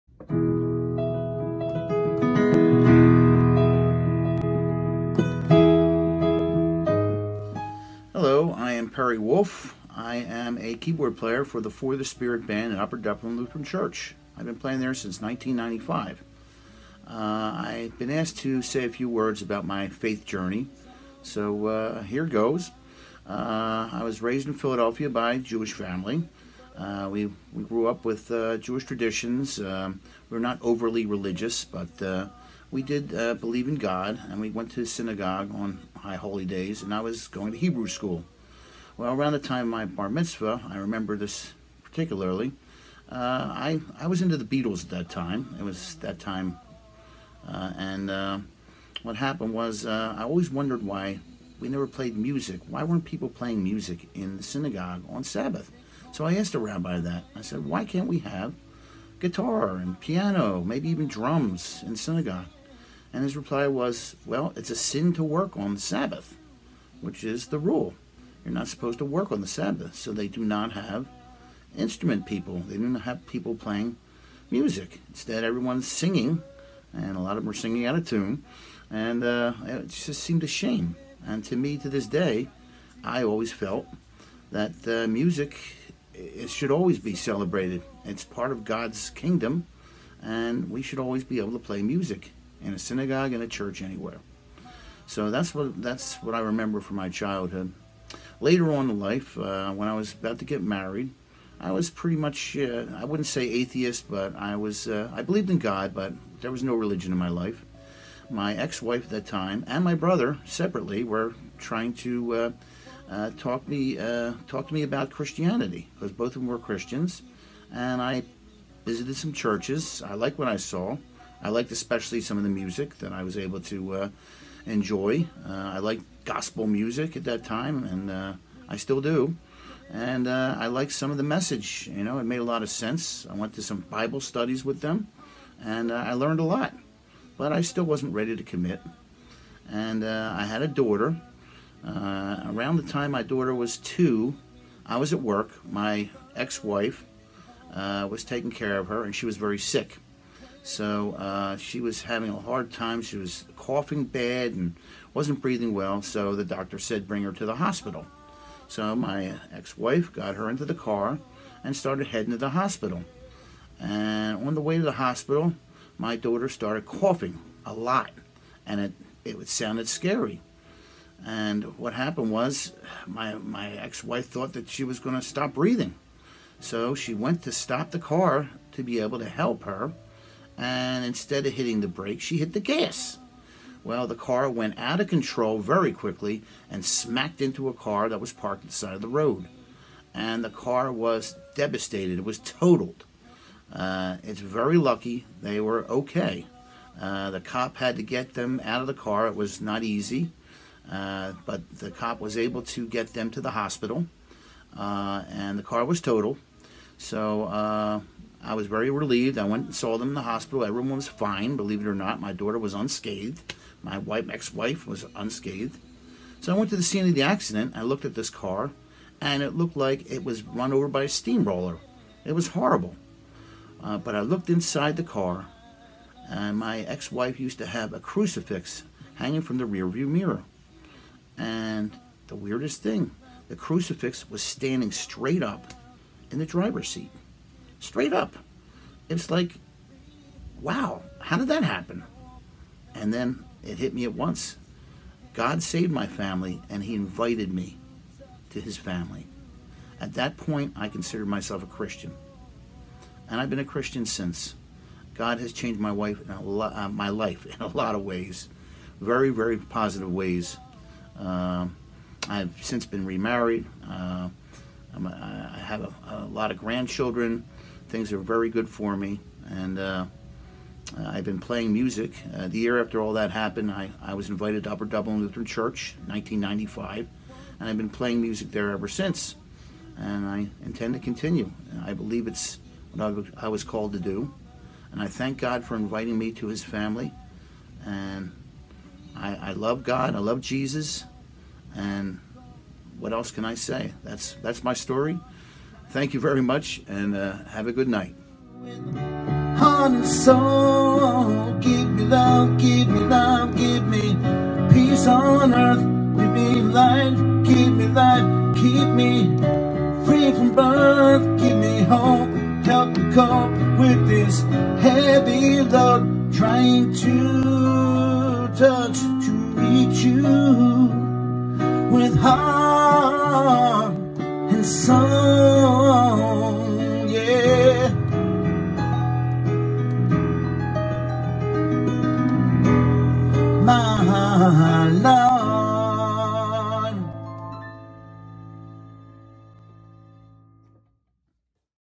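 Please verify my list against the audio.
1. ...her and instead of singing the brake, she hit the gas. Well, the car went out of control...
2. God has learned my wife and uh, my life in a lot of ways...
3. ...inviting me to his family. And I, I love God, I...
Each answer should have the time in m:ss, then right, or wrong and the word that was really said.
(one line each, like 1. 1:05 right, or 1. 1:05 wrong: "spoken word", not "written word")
1. 2:59 wrong: "hitting", not "singing"
2. 4:15 wrong: "changed", not "learned"
3. 4:45 right.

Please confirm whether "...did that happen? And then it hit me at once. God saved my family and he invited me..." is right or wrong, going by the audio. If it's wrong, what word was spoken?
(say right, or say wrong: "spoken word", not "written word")
right.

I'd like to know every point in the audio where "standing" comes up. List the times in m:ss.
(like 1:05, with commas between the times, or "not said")
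3:54.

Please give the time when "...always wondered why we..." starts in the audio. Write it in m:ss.
0:50.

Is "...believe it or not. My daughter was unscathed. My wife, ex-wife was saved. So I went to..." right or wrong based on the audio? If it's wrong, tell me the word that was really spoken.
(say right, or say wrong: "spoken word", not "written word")
wrong: "unscathed", not "saved".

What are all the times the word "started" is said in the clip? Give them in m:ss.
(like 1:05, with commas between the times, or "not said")
2:41, 2:46.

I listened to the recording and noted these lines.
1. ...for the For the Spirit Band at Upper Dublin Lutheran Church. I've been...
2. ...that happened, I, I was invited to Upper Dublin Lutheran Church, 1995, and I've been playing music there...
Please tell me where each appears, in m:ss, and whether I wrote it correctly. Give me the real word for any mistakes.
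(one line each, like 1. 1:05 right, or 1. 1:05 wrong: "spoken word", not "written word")
1. 0:11 right
2. 4:33 right.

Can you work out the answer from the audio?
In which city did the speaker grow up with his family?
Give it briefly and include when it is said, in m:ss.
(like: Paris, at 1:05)
Philadelphia, at 0:24.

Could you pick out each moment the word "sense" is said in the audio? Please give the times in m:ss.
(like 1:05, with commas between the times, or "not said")
2:12.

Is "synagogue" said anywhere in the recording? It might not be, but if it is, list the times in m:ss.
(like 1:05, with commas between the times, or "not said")
0:34, 0:54, 1:01, 1:32.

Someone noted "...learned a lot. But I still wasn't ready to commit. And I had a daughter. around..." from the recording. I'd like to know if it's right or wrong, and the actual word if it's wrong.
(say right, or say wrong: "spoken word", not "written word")
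right.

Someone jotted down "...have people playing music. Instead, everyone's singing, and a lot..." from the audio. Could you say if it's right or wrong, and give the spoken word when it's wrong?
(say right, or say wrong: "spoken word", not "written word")
right.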